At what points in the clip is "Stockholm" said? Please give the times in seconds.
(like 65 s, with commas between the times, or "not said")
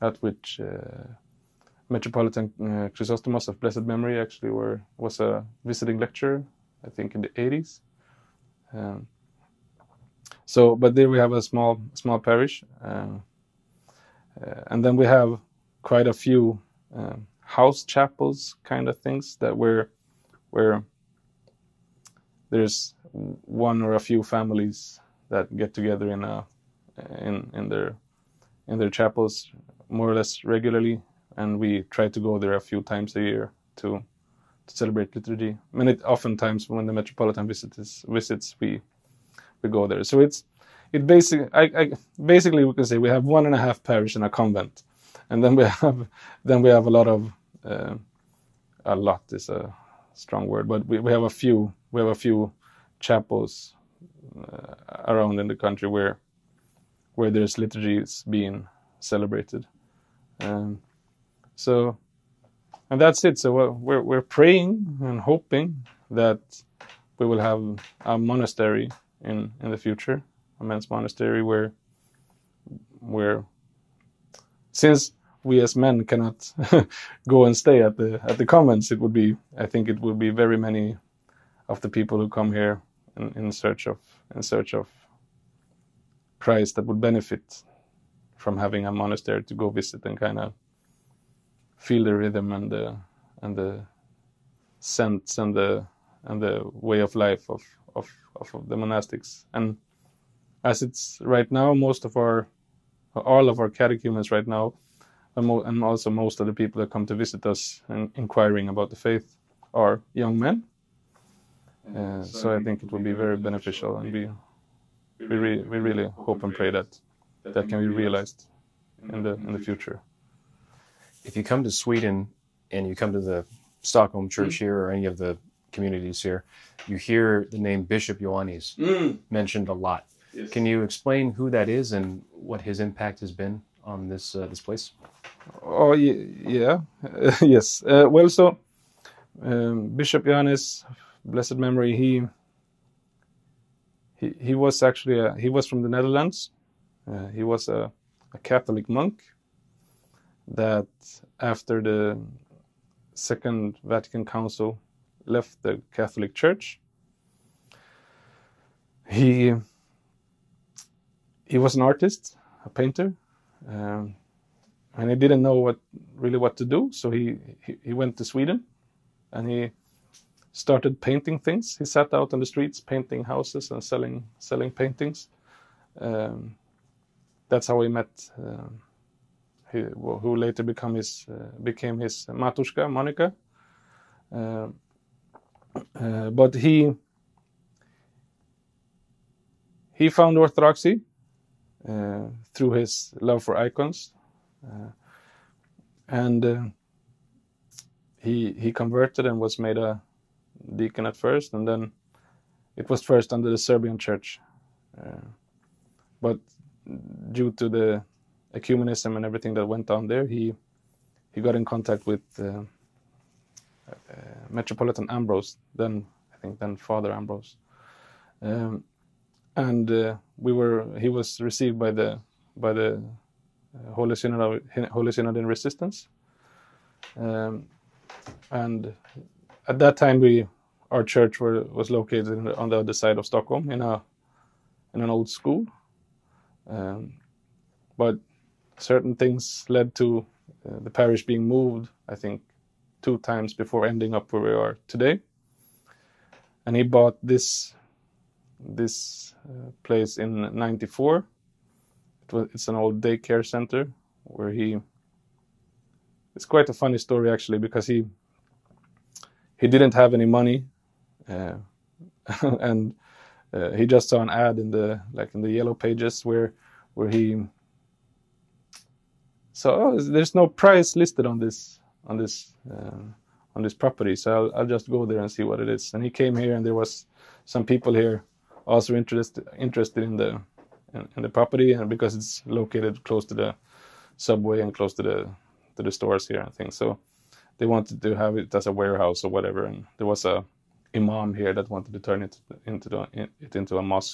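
123 s, 233 s.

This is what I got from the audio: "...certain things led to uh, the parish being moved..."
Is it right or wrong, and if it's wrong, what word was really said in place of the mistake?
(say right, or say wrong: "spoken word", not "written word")
right.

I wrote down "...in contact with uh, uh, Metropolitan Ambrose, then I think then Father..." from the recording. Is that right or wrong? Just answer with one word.
right.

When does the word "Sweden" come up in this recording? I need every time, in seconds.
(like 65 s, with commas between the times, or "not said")
121 s, 168 s.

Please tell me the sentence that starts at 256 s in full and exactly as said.
It's quite a funny story actually because he.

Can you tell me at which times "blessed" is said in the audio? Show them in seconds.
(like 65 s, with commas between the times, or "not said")
3 s, 141 s.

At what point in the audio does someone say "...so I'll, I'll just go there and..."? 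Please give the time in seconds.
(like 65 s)
274 s.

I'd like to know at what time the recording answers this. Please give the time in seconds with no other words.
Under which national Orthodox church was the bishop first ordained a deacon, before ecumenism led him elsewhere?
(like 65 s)
203 s.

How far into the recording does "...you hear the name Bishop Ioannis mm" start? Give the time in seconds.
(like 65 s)
126 s.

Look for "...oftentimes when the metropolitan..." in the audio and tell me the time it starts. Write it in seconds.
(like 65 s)
36 s.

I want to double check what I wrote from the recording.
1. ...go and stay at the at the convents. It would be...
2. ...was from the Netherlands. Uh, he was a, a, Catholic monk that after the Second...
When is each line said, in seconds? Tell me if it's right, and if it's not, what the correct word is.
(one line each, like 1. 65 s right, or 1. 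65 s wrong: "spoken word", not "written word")
1. 77 s right
2. 145 s right.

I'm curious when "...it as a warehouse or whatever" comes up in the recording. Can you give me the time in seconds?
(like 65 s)
288 s.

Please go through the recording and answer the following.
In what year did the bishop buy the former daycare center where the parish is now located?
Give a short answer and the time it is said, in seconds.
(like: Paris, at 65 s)
1994, at 250 s.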